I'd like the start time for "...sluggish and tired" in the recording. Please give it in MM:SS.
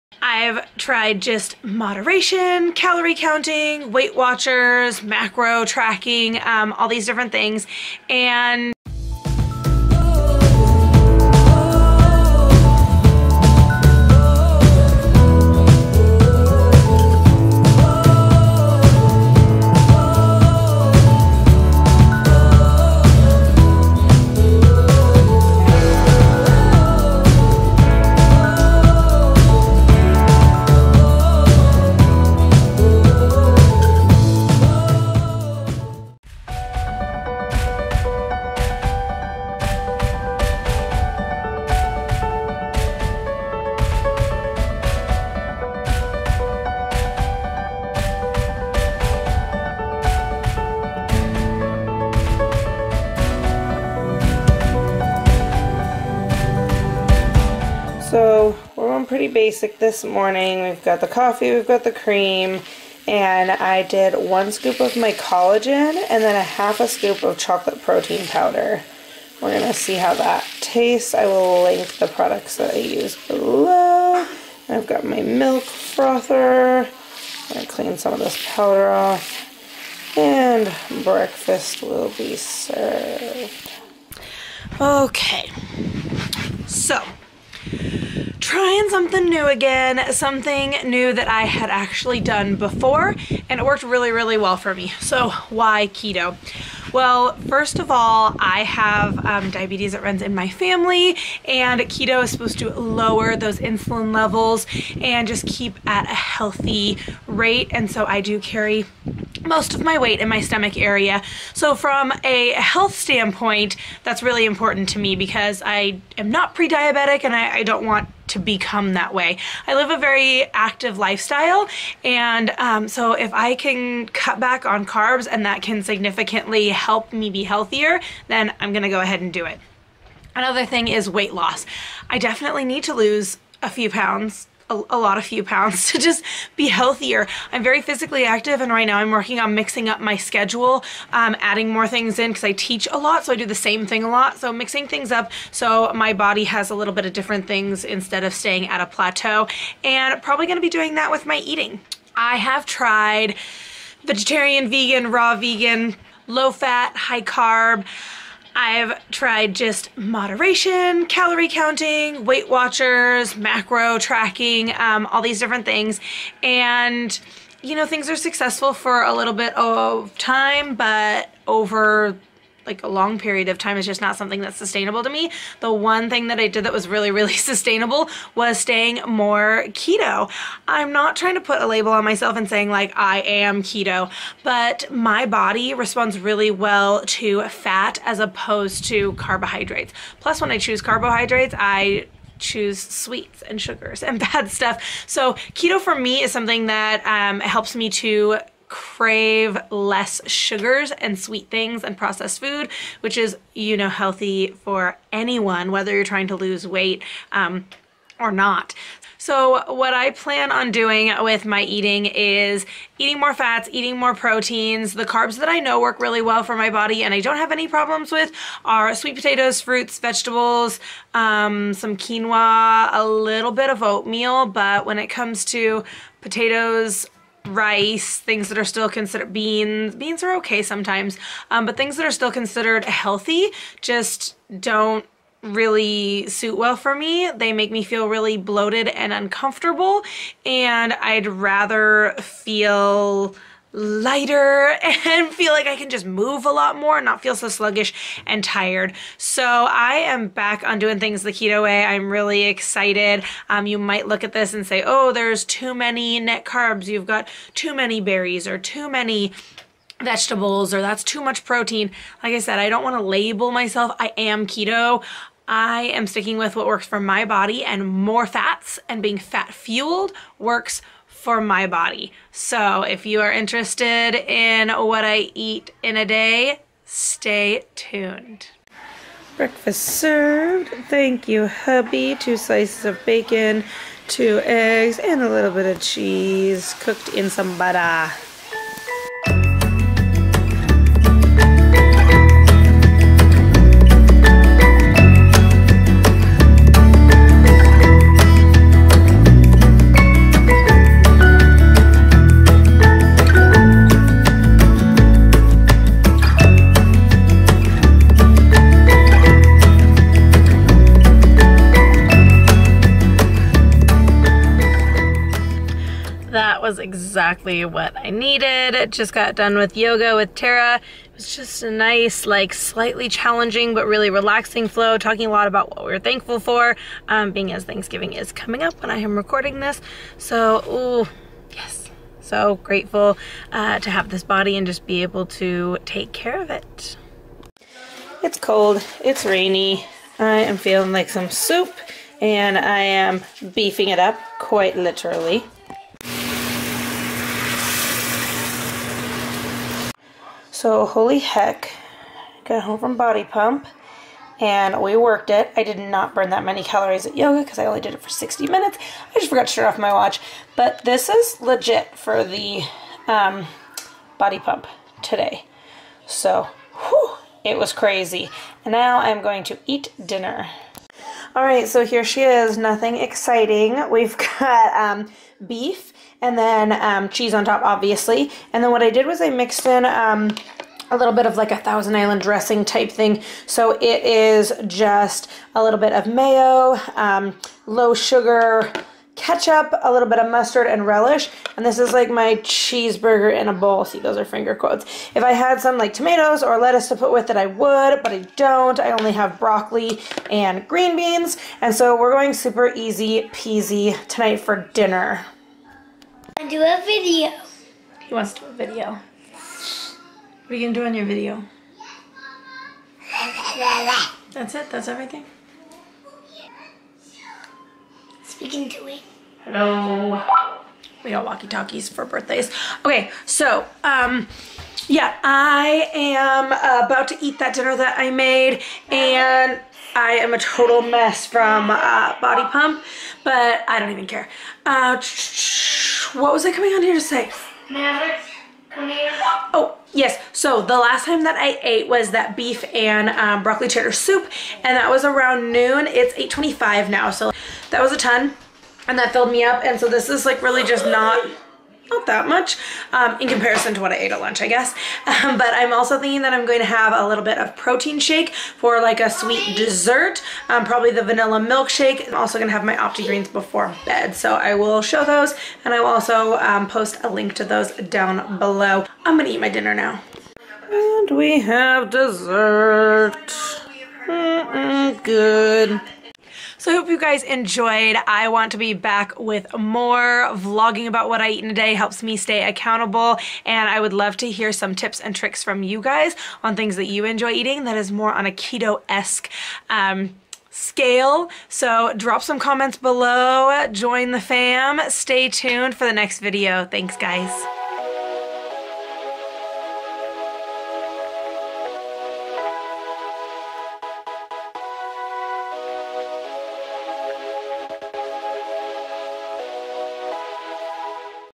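04:07.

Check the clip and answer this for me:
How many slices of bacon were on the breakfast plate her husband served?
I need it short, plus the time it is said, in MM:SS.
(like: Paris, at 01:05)
2, at 04:42.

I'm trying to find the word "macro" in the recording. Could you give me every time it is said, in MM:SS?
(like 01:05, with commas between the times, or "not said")
00:05, 02:43.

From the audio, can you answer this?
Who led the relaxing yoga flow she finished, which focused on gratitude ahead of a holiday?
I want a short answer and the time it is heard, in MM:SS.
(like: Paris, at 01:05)
Tara, at 05:20.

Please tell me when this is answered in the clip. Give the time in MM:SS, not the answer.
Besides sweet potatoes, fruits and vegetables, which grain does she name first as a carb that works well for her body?
03:41.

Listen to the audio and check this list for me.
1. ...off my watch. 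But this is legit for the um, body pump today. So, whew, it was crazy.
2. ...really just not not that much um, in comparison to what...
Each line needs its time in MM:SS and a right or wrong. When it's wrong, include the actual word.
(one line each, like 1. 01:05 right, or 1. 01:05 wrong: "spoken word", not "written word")
1. 05:59 right
2. 07:30 right.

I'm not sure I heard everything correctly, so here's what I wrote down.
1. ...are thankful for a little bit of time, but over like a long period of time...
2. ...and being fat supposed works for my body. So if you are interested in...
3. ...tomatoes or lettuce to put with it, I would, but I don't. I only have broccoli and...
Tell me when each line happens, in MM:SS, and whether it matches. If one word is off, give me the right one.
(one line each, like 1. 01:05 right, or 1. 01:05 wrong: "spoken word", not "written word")
1. 02:48 wrong: "successful", not "thankful"
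2. 04:28 wrong: "fueled", not "supposed"
3. 06:35 right.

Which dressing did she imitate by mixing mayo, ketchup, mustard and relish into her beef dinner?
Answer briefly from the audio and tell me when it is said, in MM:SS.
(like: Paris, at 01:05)
Thousand Island, at 06:21.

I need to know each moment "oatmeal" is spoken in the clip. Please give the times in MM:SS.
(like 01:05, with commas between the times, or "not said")
03:43.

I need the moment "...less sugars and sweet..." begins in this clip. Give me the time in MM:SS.
03:19.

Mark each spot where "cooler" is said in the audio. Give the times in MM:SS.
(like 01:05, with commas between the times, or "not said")
not said.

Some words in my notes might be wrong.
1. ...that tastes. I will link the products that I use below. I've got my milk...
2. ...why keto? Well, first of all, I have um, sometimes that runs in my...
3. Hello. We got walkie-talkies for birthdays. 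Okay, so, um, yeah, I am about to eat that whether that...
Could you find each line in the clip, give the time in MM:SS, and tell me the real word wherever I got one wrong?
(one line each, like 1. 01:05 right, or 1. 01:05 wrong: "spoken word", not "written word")
1. 01:10 right
2. 01:35 wrong: "diabetes", not "sometimes"
3. 06:59 wrong: "dinner", not "whether".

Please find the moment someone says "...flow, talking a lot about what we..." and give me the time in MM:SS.
05:24.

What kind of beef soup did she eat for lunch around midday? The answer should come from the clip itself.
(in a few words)
broccoli cheddar.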